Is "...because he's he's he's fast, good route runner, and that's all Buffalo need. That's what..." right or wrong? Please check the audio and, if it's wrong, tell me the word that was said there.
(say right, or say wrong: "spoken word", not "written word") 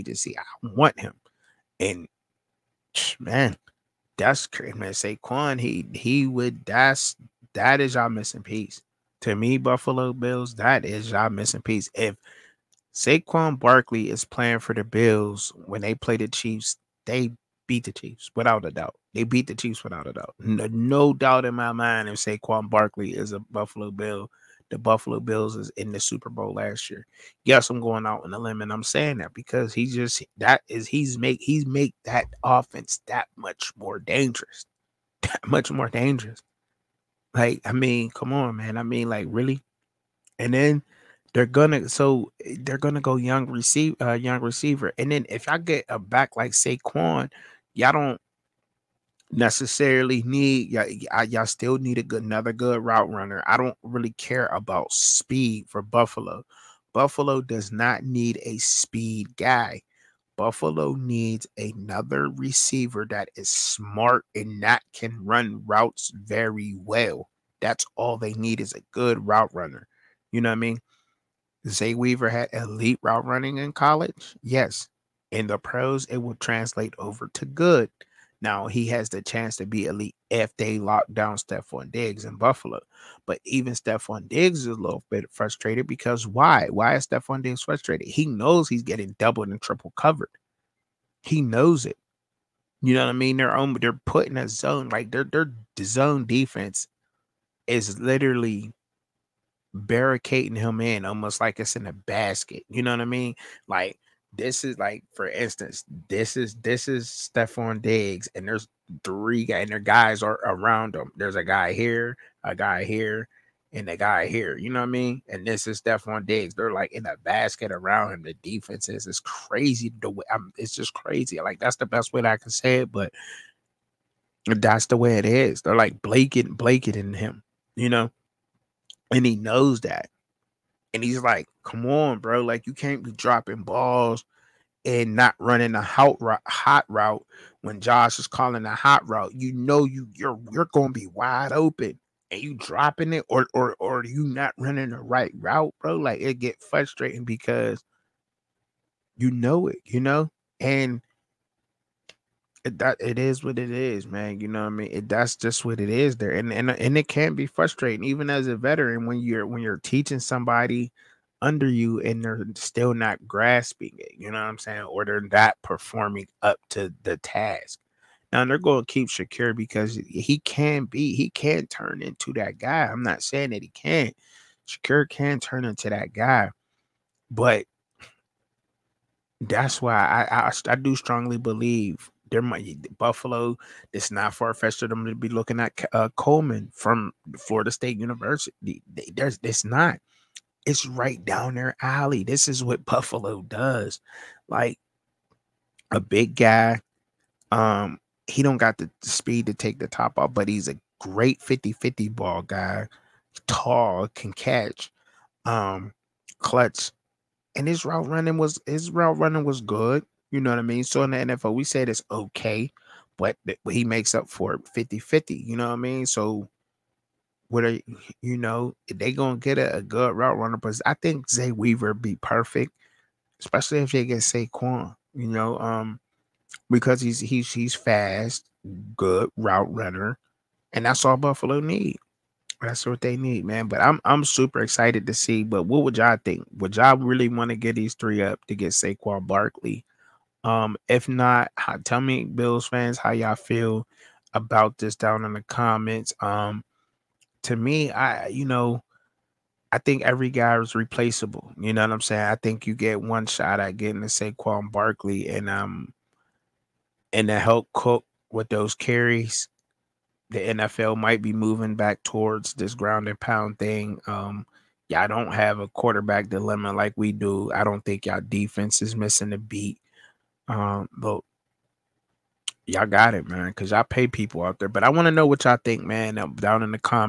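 right.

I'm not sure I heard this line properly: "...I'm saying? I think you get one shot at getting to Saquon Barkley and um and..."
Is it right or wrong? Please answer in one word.
right.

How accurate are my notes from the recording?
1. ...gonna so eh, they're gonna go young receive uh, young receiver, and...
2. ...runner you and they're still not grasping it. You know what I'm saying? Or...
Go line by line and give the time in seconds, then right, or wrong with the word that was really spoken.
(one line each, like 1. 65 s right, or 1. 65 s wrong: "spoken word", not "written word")
1. 41 s right
2. 161 s wrong: "under", not "runner".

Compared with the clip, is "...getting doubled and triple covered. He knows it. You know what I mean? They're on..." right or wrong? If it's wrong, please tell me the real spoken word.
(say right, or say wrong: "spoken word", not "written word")
right.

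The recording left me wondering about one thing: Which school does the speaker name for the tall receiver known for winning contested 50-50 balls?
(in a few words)
Florida State University.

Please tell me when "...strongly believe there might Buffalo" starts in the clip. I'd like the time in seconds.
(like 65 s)
180 s.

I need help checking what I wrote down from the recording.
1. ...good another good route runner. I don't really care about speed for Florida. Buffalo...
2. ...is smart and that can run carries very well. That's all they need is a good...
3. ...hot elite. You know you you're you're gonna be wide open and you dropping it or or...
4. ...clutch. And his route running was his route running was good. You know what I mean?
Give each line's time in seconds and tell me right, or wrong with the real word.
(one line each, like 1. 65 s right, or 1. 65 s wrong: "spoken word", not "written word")
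1. 52 s wrong: "Buffalo", not "Florida"
2. 63 s wrong: "routes", not "carries"
3. 138 s wrong: "route", not "elite"
4. 206 s right.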